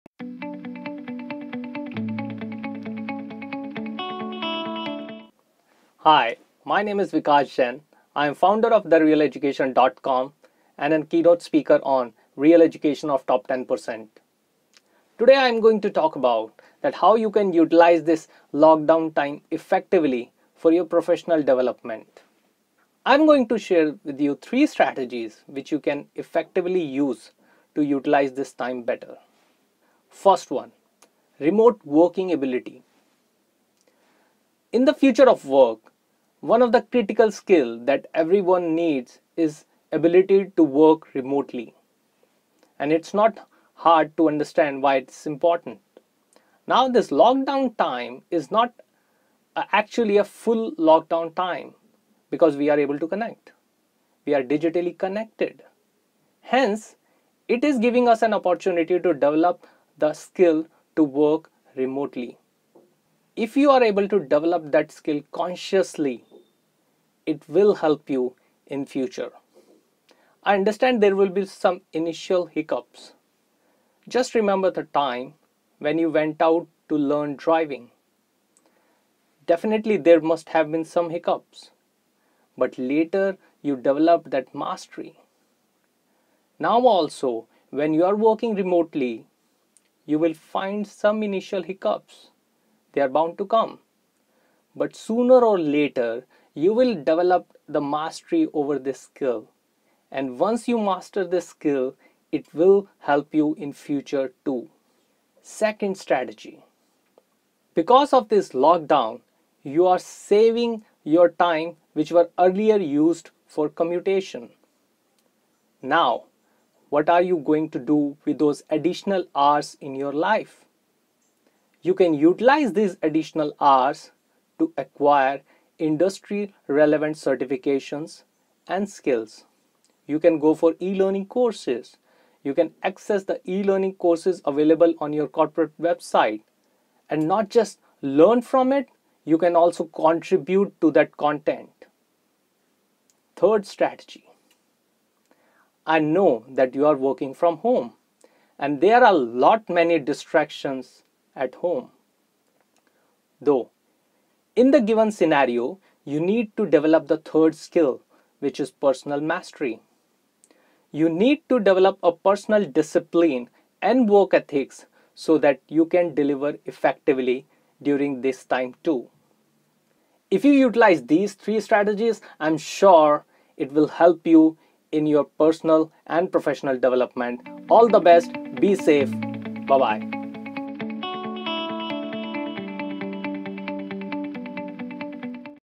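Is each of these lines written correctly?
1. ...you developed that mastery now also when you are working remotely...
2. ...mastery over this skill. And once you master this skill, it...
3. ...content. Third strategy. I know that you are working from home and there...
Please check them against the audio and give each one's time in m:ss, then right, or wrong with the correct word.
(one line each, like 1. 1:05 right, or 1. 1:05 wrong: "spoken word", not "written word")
1. 1:23 right
2. 1:37 right
3. 2:21 right.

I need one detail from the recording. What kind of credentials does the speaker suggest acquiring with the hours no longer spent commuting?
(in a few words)
Industry relevant certifications.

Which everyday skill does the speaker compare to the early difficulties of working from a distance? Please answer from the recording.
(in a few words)
Driving.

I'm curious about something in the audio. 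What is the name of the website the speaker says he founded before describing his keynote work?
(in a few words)
therealeducation.com.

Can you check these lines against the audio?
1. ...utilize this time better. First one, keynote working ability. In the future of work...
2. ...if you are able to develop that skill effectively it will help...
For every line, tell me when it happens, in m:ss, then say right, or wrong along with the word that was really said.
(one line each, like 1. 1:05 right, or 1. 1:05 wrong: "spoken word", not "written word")
1. 0:27 wrong: "remote", not "keynote"
2. 1:03 wrong: "consciously", not "effectively".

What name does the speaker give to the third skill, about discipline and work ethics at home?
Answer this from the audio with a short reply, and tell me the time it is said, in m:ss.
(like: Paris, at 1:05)
Personal mastery, at 2:38.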